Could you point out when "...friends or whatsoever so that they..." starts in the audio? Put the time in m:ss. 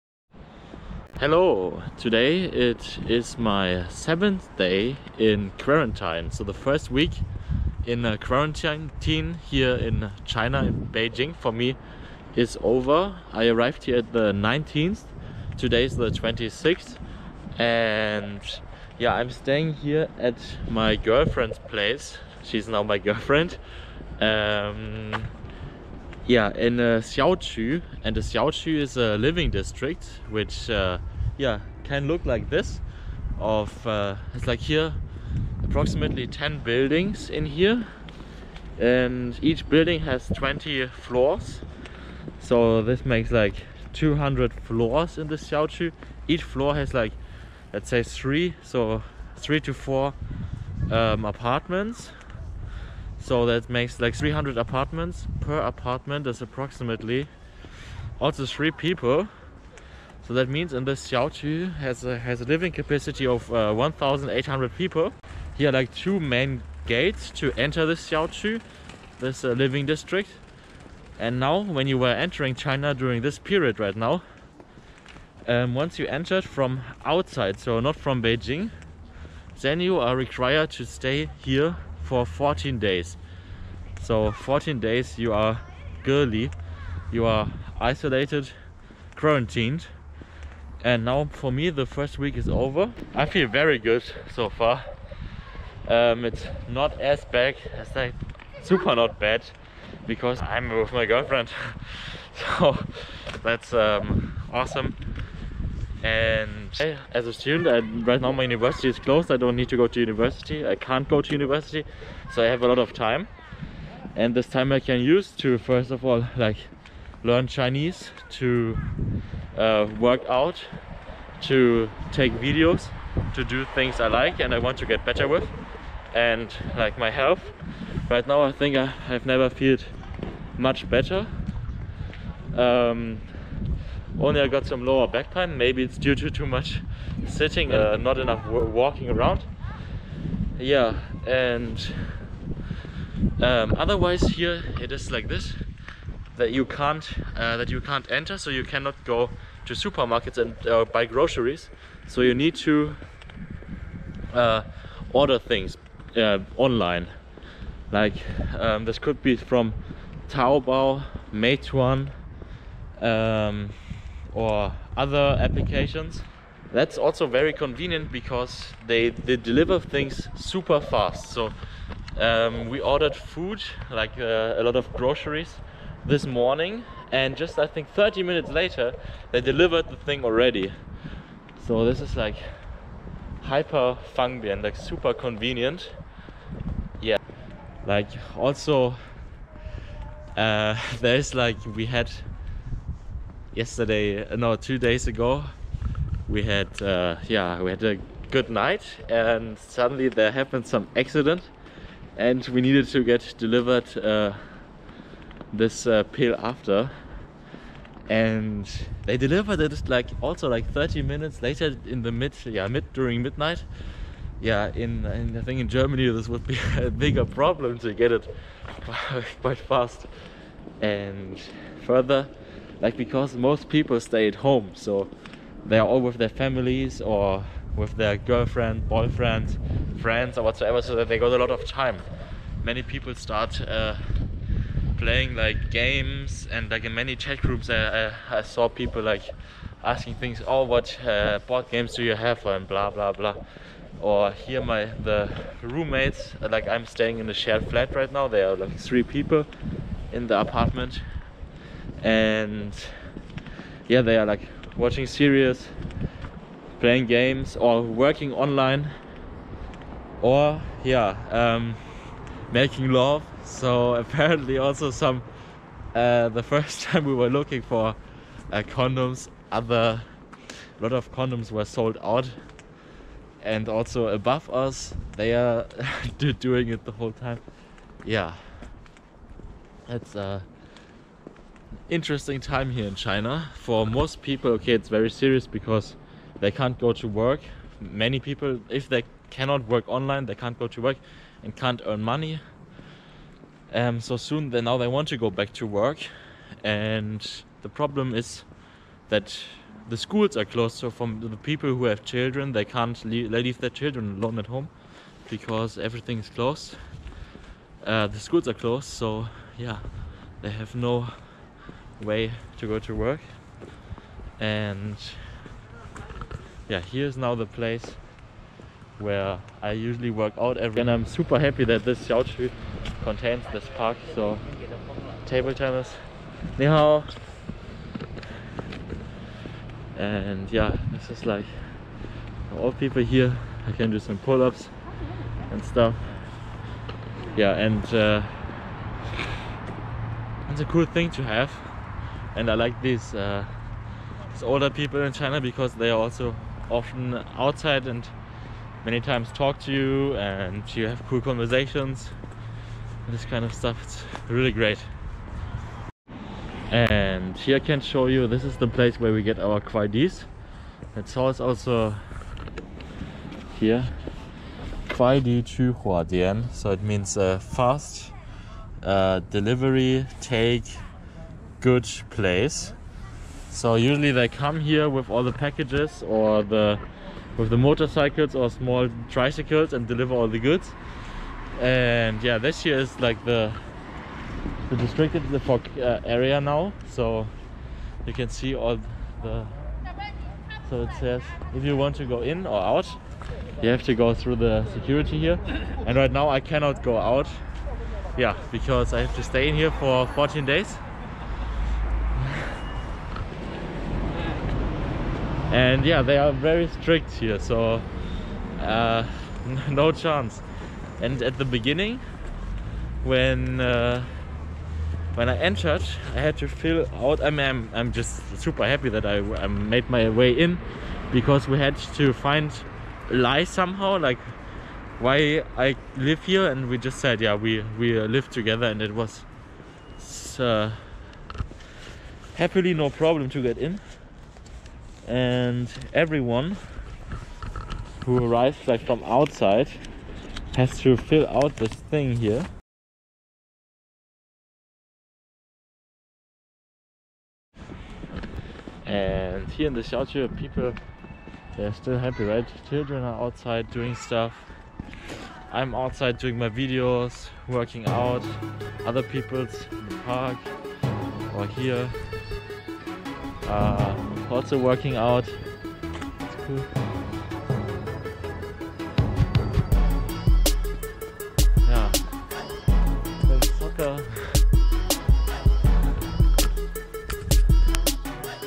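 3:50.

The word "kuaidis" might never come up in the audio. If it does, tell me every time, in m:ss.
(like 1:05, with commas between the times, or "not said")
5:59, 6:04.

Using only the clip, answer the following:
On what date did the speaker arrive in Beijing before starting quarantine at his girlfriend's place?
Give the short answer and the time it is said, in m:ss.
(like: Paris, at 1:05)
19th, at 0:14.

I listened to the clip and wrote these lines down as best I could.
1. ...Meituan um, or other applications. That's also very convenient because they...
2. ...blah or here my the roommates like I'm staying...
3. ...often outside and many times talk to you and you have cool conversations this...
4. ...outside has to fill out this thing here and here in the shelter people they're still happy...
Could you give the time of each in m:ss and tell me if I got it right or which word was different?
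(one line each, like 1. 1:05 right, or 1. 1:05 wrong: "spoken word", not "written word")
1. 2:41 right
2. 4:03 right
3. 5:46 right
4. 7:19 right.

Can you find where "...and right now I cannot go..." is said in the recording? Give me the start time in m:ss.
6:35.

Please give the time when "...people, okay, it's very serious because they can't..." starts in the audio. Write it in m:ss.
4:44.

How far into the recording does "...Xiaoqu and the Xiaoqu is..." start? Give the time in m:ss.
0:27.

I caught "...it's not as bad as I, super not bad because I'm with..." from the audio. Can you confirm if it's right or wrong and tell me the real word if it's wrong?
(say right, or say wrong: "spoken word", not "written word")
right.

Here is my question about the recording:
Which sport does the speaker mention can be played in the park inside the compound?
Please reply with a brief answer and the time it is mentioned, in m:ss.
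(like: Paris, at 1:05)
Table tennis, at 5:25.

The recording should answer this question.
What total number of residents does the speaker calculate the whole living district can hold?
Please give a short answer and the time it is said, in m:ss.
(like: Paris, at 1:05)
1,800, at 1:03.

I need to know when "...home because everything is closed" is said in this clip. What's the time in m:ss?
5:04.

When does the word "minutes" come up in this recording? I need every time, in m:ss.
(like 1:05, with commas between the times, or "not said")
2:58, 3:31.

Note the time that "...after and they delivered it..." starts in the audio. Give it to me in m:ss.
3:26.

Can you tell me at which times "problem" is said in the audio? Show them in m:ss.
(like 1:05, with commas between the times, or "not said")
3:37, 4:57, 7:12.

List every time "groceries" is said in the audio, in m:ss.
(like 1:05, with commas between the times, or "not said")
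2:31, 2:54.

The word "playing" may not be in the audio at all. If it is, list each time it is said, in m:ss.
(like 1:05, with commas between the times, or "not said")
3:54, 4:16.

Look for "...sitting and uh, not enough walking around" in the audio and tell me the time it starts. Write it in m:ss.
2:17.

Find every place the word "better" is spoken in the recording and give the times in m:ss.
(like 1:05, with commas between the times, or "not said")
2:05, 2:10.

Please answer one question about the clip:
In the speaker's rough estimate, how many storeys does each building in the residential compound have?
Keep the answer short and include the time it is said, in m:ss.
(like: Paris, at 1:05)
20, at 0:40.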